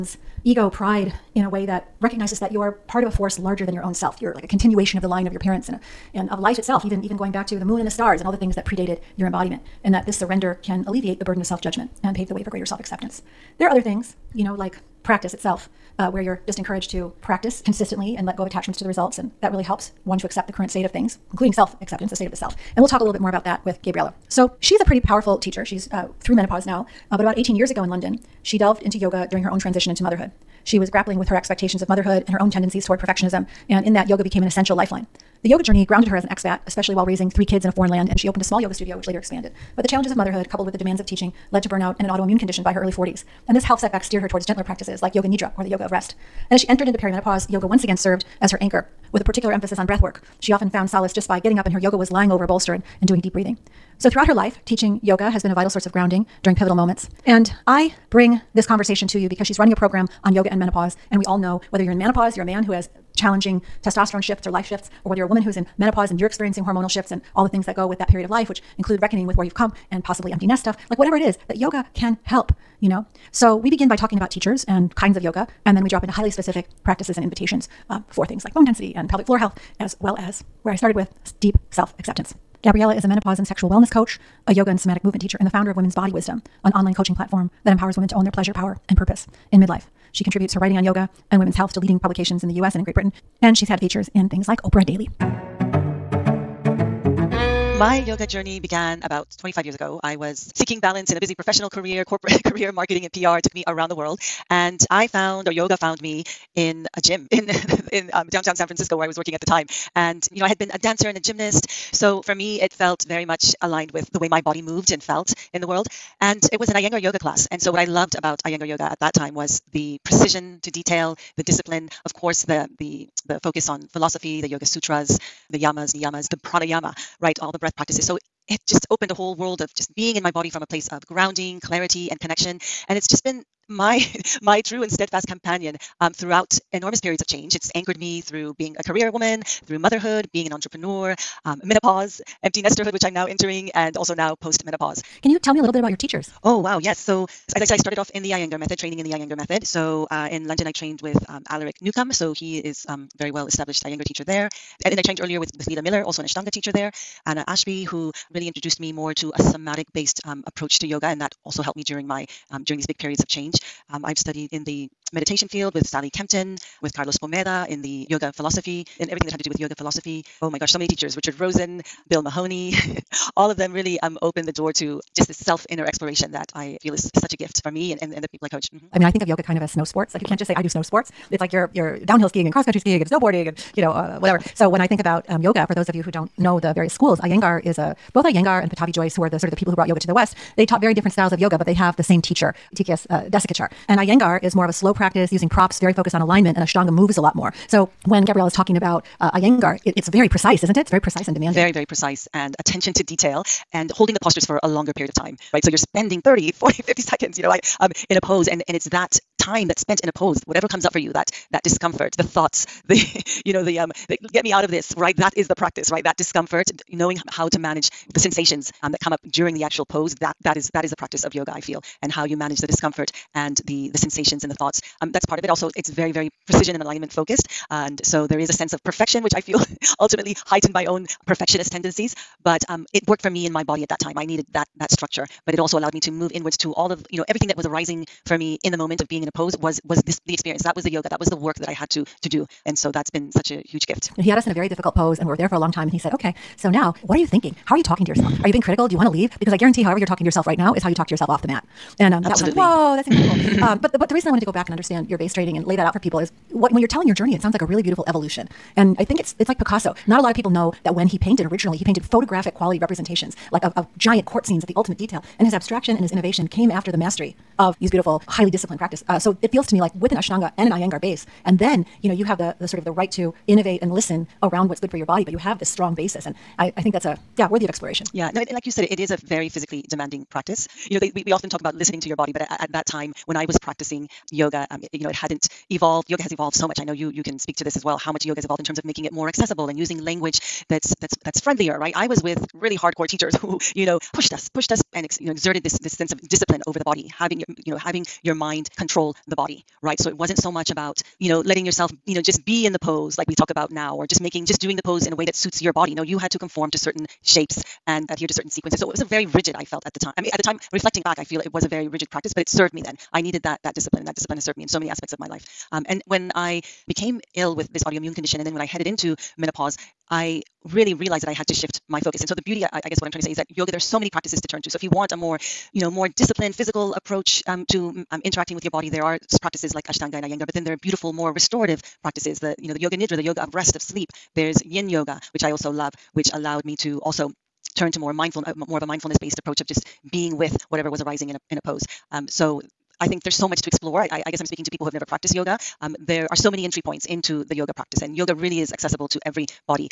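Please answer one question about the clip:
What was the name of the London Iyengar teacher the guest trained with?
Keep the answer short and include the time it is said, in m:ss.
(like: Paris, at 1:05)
Alaric Newcombe, at 2:31.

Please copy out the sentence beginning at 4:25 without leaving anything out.
And his abstraction and his innovation came after the mastery of these beautiful, highly disciplined practice.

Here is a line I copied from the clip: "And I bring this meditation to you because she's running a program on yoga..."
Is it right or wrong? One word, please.
wrong.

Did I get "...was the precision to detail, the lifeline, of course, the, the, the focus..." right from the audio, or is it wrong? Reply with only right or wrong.
wrong.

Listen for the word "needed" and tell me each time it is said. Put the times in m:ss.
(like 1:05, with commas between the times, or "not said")
3:54, 5:13.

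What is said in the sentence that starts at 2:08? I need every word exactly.
So it just opened a whole world of just being in my body from a place of grounding, clarity, and connection.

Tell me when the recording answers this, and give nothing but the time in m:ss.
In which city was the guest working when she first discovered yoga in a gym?
1:48.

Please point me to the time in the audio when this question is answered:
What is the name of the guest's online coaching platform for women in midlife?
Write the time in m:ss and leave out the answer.
1:25.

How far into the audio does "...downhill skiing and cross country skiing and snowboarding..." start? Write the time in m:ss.
3:02.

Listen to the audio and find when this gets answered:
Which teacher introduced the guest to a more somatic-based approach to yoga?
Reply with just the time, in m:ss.
2:37.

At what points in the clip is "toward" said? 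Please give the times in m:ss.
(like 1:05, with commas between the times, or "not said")
0:32, 0:44.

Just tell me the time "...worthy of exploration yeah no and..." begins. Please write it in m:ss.
4:37.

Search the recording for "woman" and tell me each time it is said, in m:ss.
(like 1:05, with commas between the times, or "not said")
1:05, 2:19.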